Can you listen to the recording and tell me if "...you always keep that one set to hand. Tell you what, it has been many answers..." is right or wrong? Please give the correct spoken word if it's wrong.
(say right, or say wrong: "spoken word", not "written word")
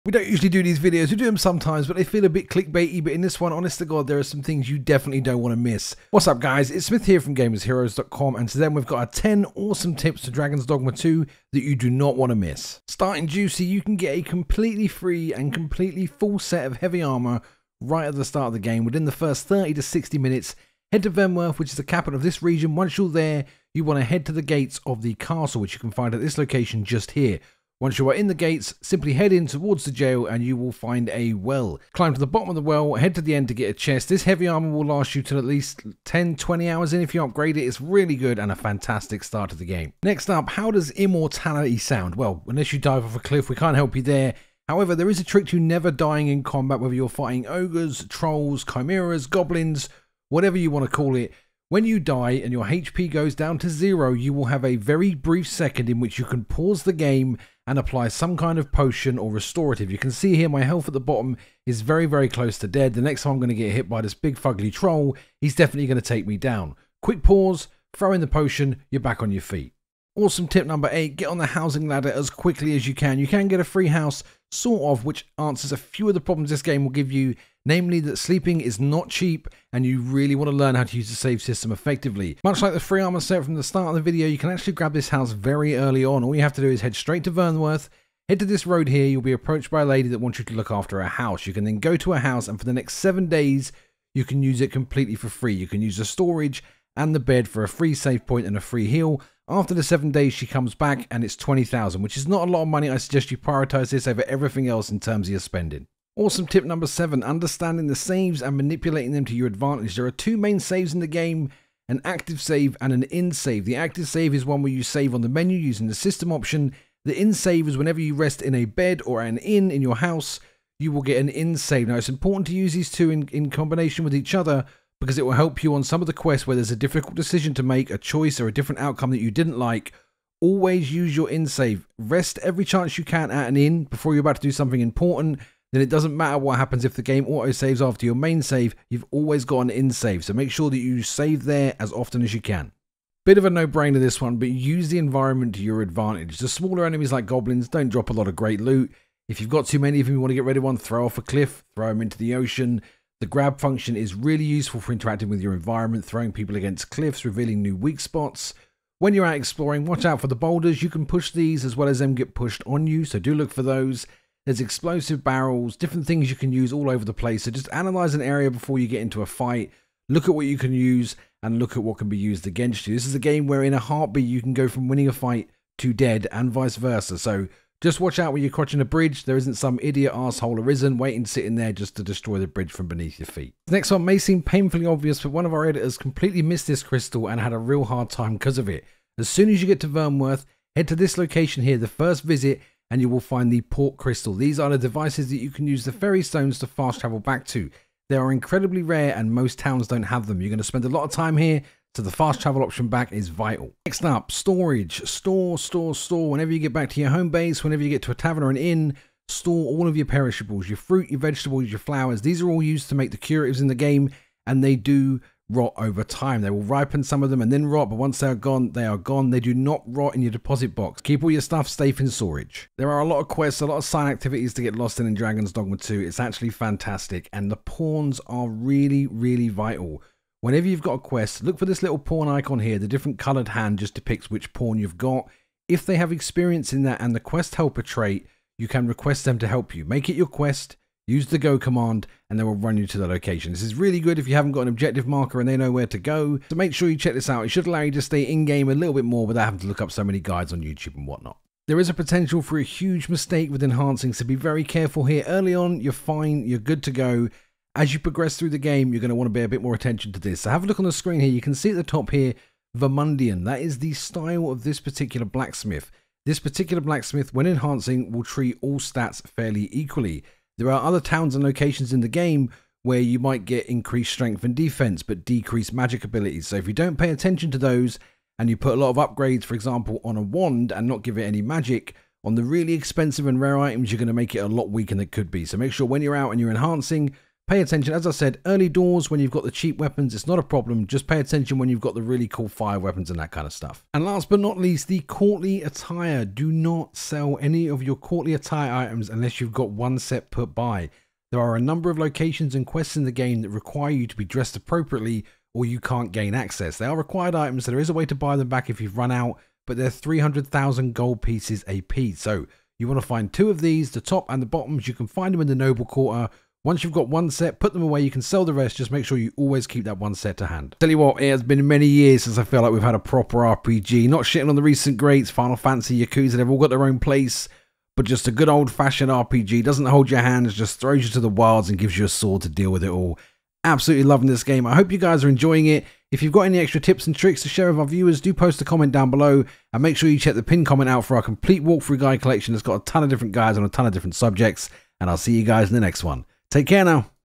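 wrong: "years", not "answers".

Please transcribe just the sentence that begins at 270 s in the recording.
There are other towns and locations in the game where you might get increased strength and defense, but decreased magic abilities.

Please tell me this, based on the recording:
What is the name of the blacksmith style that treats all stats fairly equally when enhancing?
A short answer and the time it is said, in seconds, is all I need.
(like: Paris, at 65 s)
Vermundian, at 262 s.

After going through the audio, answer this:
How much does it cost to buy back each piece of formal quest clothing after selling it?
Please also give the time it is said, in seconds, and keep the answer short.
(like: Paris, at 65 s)
300,000 gold, at 309 s.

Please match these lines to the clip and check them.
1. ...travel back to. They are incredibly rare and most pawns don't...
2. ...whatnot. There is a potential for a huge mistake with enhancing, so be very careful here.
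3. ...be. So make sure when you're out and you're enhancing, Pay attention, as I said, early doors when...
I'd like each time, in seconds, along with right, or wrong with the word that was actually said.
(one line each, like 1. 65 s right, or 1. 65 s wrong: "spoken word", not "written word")
1. 196 s wrong: "towns", not "pawns"
2. 251 s right
3. 285 s right.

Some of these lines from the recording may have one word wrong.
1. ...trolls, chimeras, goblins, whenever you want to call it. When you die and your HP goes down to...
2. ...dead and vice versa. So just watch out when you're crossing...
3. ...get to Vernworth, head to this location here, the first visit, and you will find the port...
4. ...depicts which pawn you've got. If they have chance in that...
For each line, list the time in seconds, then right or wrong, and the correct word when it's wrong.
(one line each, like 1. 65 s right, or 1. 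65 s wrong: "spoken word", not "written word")
1. 48 s wrong: "whatever", not "whenever"
2. 175 s right
3. 189 s right
4. 233 s wrong: "experience", not "chance".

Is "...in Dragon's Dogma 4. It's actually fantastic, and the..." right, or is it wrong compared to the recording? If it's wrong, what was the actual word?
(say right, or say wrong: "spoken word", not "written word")
wrong: "2", not "4".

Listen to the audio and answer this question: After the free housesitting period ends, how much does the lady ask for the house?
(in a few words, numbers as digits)
20,000.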